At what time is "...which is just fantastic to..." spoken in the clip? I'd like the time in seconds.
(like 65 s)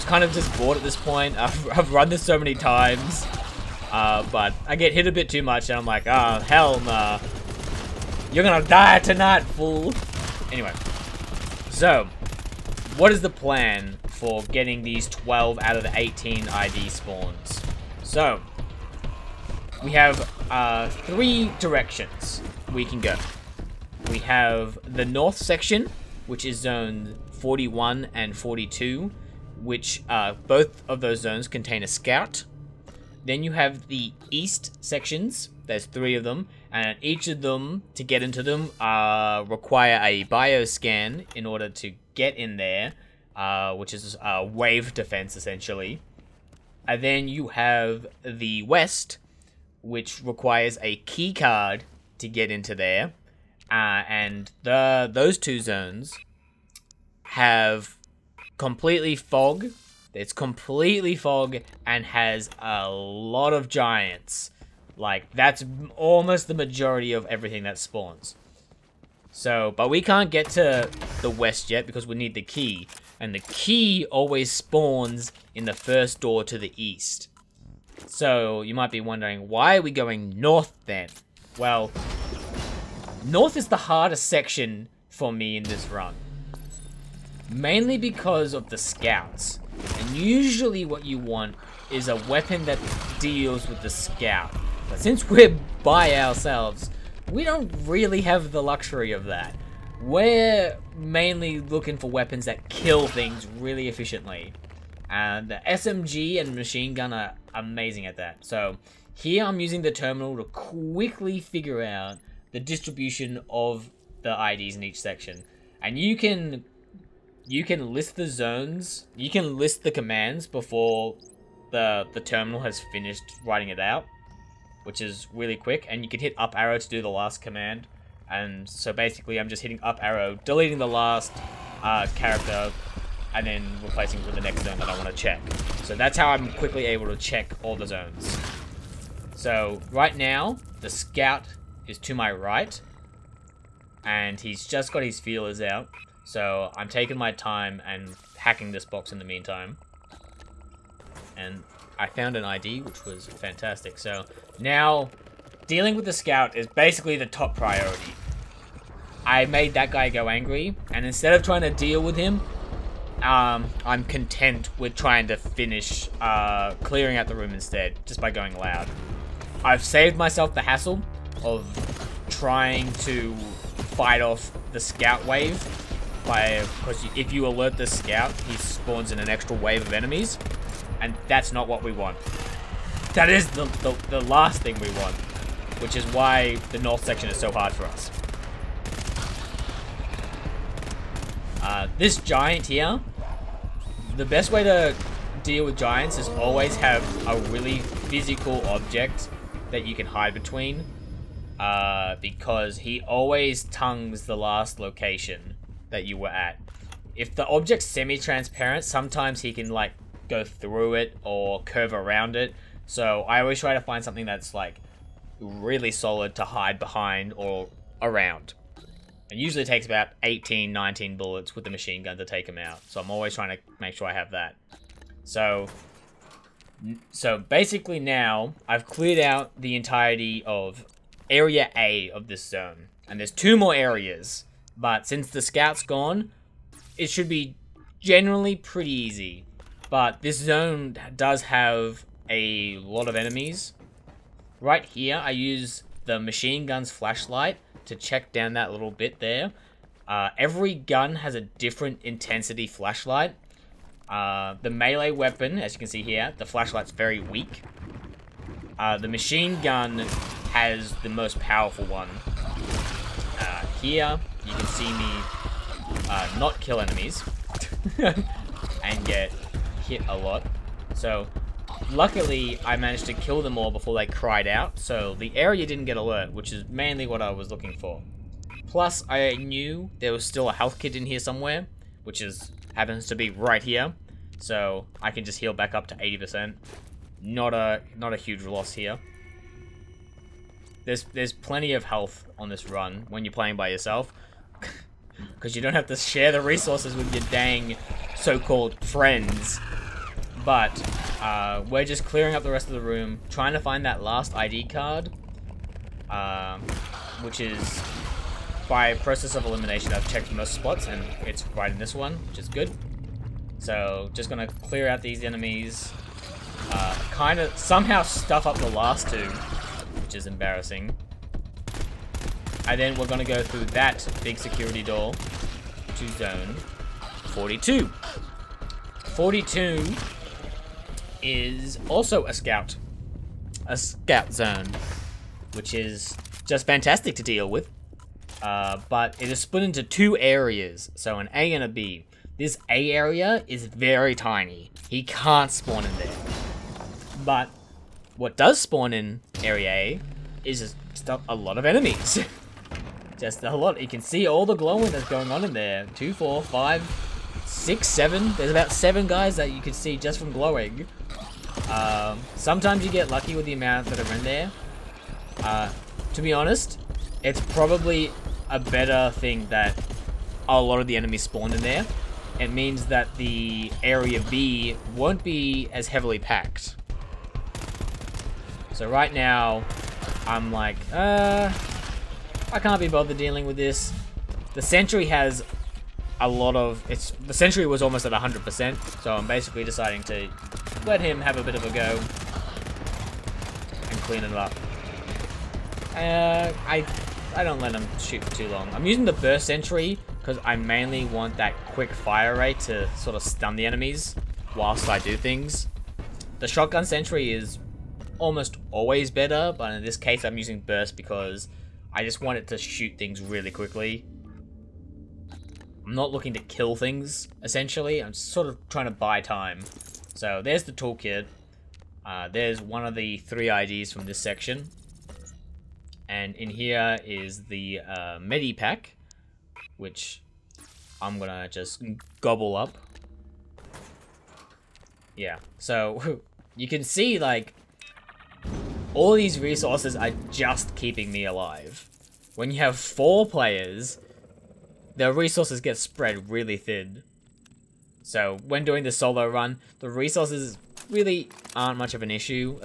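335 s.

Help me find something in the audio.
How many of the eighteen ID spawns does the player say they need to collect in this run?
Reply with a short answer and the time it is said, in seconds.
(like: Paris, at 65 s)
12, at 15 s.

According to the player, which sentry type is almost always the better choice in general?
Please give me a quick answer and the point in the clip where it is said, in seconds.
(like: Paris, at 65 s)
Shotgun Sentry, at 406 s.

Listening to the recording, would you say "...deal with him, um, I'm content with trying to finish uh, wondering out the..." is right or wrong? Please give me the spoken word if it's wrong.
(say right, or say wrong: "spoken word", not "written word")
wrong: "clearing", not "wondering".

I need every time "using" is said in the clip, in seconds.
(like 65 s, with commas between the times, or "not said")
109 s, 398 s, 410 s.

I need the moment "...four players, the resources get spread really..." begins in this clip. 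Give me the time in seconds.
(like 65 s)
442 s.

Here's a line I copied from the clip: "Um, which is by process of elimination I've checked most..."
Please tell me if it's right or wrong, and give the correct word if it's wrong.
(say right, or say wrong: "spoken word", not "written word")
right.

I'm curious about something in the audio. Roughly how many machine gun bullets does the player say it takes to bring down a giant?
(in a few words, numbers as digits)
18 or 19.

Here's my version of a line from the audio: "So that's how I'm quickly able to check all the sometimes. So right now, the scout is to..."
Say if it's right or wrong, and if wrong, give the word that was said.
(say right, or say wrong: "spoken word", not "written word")
wrong: "zones", not "sometimes".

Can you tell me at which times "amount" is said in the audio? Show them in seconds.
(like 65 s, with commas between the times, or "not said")
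363 s.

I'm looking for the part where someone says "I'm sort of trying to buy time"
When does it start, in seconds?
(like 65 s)
418 s.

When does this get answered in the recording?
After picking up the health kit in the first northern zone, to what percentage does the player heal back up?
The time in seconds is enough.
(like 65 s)
285 s.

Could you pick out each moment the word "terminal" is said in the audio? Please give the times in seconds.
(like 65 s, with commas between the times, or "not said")
109 s, 122 s.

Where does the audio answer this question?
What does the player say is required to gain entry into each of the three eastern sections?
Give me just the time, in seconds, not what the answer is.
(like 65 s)
40 s.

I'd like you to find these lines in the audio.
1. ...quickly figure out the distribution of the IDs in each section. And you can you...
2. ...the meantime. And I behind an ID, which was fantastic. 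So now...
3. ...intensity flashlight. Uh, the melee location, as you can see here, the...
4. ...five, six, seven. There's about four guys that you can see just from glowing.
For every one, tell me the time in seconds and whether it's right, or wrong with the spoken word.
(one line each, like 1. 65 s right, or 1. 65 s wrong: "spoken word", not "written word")
1. 110 s right
2. 149 s wrong: "found", not "behind"
3. 252 s wrong: "weapon", not "location"
4. 356 s wrong: "seven", not "four".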